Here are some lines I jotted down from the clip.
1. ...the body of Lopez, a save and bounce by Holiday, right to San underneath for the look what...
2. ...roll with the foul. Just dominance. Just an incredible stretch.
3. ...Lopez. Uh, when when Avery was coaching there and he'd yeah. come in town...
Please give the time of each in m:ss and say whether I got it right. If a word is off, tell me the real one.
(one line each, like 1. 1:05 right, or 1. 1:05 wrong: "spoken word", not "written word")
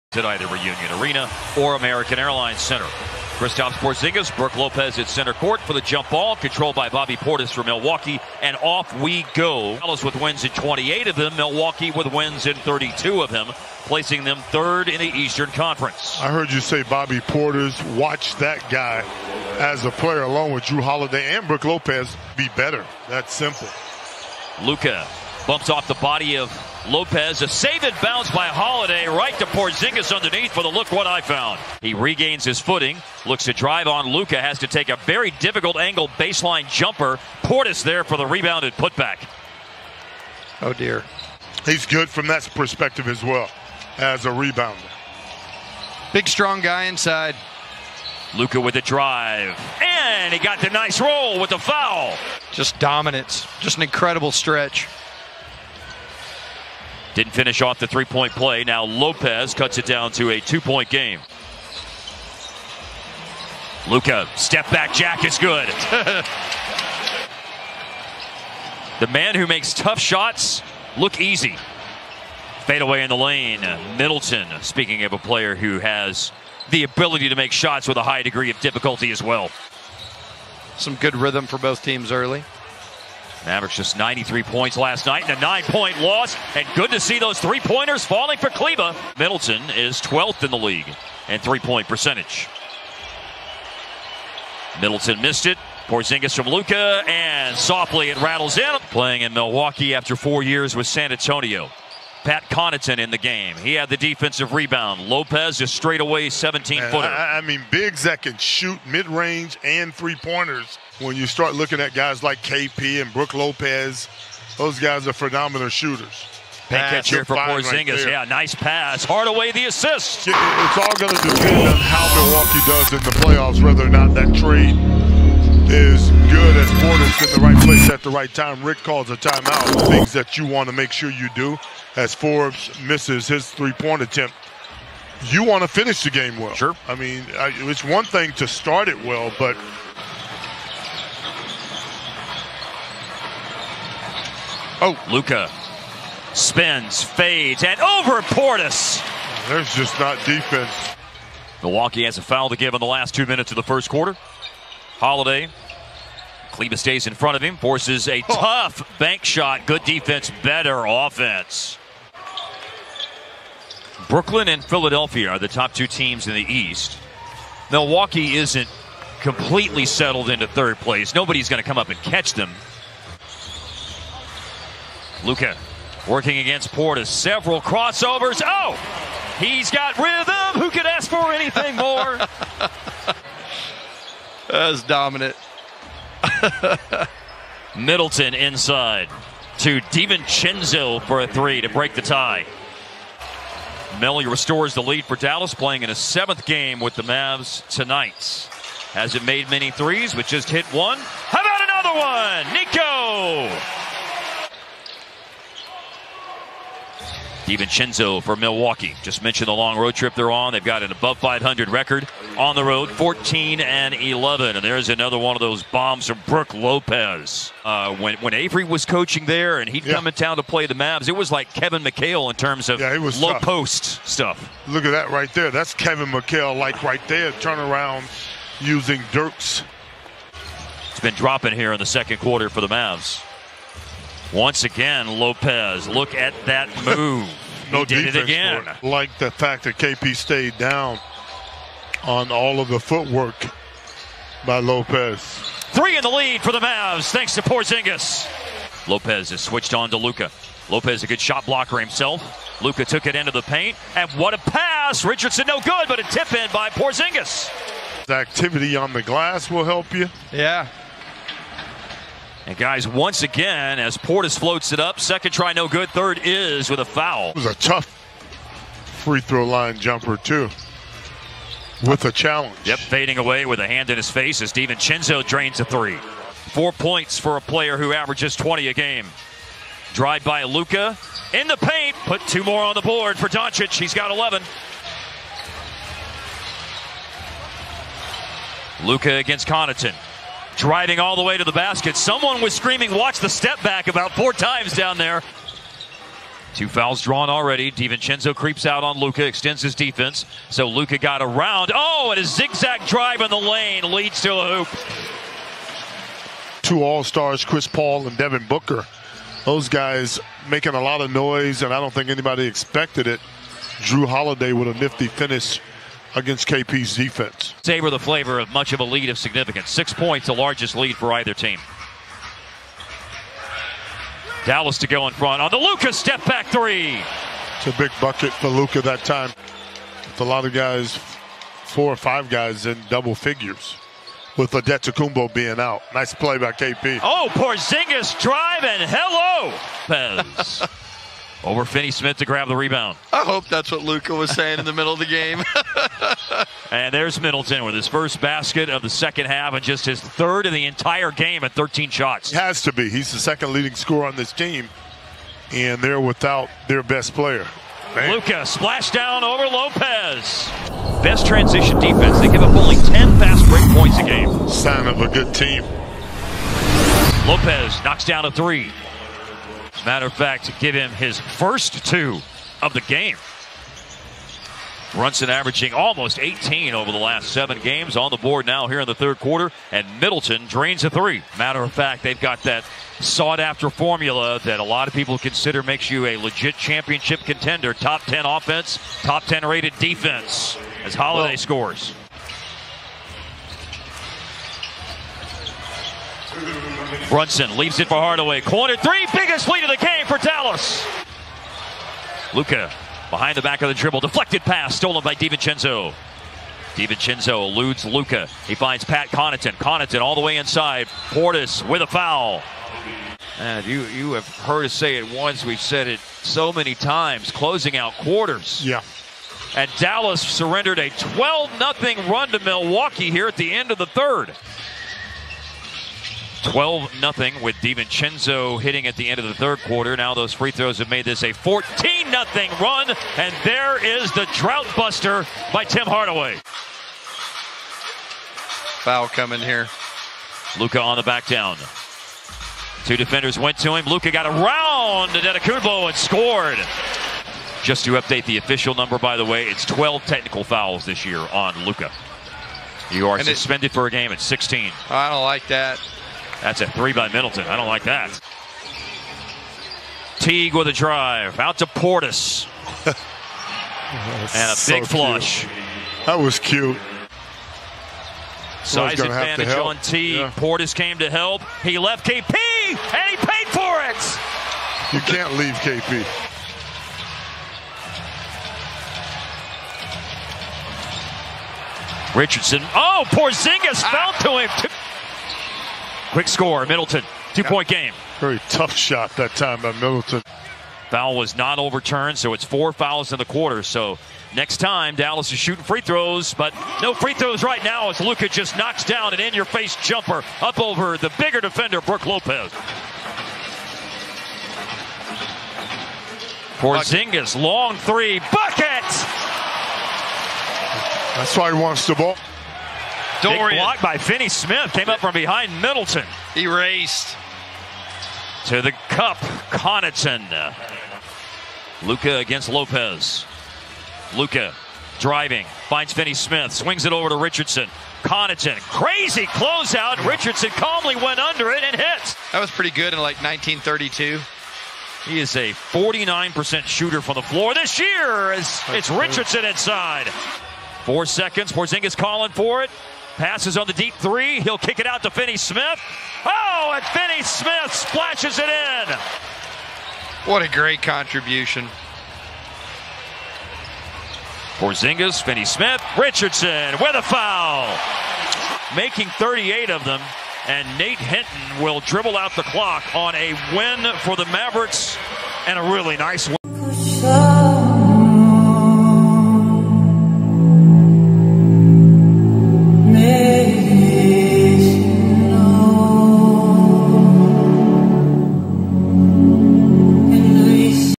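1. 0:25 wrong: "Porzingis", not "San"
2. 0:50 right
3. 3:36 right.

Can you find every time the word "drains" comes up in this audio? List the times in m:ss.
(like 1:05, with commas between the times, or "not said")
4:35, 6:20.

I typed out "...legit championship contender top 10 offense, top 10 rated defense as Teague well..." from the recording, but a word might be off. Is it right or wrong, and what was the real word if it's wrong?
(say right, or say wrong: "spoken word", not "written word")
wrong: "Holiday", not "Teague".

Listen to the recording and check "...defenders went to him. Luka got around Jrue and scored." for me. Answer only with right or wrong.
wrong.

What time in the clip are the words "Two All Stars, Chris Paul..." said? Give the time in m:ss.
5:06.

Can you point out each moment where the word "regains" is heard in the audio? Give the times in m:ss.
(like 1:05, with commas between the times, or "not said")
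0:31.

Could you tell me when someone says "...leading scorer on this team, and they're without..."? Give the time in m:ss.
5:53.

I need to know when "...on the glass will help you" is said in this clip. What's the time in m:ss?
4:18.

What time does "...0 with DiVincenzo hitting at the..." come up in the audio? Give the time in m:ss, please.
7:06.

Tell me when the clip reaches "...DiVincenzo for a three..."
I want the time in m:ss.
3:09.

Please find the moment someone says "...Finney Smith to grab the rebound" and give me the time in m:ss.
5:41.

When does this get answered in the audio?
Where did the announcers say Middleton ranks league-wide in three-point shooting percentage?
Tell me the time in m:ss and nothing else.
1:30.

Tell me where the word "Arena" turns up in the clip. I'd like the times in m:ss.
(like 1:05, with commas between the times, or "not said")
0:01.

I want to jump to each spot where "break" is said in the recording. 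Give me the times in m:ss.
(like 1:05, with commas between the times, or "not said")
3:11, 6:03.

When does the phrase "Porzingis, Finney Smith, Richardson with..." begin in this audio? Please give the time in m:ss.
9:14.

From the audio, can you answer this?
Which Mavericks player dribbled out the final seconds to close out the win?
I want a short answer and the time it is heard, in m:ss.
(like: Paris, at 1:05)
Nate Hinton, at 9:20.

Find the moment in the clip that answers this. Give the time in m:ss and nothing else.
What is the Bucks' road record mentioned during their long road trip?
3:32.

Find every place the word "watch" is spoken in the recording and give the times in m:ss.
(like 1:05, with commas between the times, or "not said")
0:17, 4:52.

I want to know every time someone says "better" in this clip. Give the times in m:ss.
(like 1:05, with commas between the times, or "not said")
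0:22, 2:40.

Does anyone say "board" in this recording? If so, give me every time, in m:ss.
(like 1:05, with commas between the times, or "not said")
4:42, 6:18.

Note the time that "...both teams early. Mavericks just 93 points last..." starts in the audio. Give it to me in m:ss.
1:21.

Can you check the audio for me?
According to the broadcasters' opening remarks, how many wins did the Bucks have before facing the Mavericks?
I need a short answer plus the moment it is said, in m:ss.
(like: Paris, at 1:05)
32, at 0:12.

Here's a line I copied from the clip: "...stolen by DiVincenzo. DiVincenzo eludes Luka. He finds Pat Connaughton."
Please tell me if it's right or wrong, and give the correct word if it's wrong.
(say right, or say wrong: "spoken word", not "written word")
right.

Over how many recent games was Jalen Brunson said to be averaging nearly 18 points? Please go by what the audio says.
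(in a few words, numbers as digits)
7.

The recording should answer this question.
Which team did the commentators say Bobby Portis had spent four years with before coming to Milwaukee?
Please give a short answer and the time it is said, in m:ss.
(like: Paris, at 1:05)
San Antonio, at 1:40.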